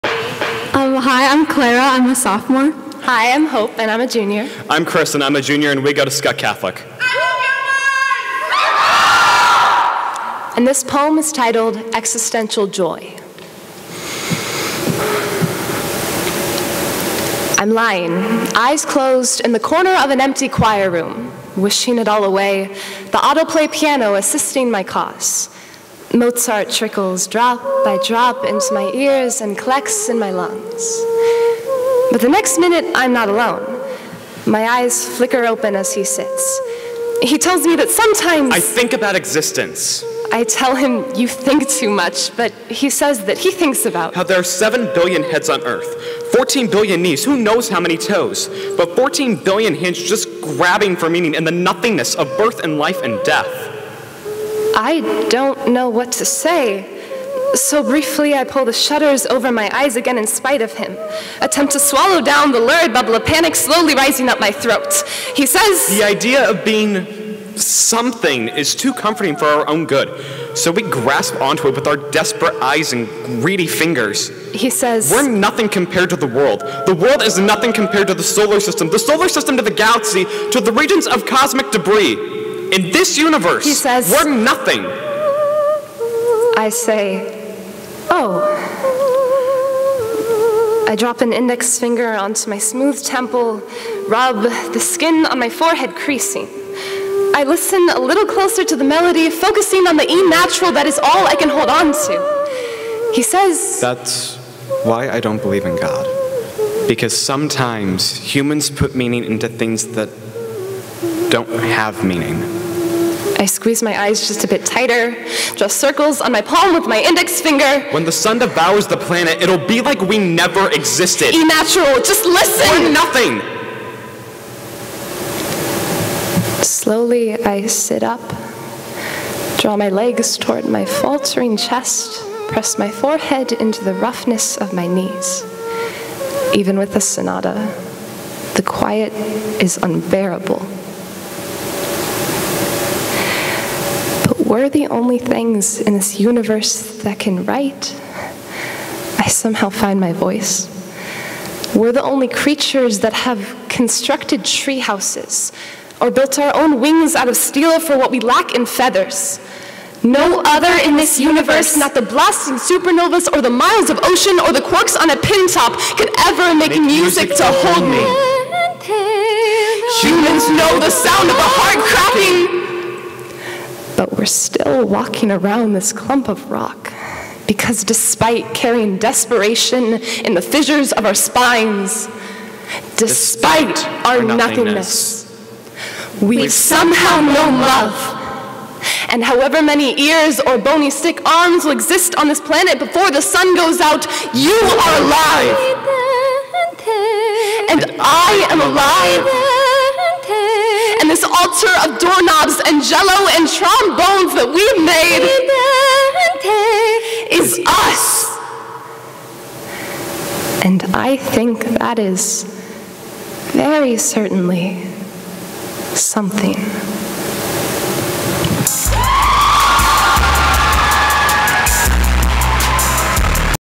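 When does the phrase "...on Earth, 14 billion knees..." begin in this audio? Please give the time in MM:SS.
00:45.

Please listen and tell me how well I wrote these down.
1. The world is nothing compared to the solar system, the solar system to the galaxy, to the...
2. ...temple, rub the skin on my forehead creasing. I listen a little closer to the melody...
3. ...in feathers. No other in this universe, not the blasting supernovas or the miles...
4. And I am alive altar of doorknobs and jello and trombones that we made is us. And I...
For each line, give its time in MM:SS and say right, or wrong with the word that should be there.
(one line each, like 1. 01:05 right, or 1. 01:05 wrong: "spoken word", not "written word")
1. 01:16 right
2. 01:33 right
3. 02:38 right
4. 03:17 right.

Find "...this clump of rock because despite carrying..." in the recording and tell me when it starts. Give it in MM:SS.
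02:55.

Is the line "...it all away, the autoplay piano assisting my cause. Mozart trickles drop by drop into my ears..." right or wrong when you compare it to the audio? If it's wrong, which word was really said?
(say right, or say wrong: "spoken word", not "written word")
right.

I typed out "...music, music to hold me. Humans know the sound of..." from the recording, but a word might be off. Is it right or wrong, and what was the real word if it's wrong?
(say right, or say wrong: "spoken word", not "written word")
right.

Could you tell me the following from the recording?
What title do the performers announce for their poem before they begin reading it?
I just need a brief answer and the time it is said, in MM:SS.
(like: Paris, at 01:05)
Existential Joy, at 00:11.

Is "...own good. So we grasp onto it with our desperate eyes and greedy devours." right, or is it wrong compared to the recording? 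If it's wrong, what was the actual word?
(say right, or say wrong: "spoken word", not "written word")
wrong: "fingers", not "devours".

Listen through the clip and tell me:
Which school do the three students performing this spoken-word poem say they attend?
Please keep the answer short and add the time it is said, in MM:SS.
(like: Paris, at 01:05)
Skutt Catholic, at 00:06.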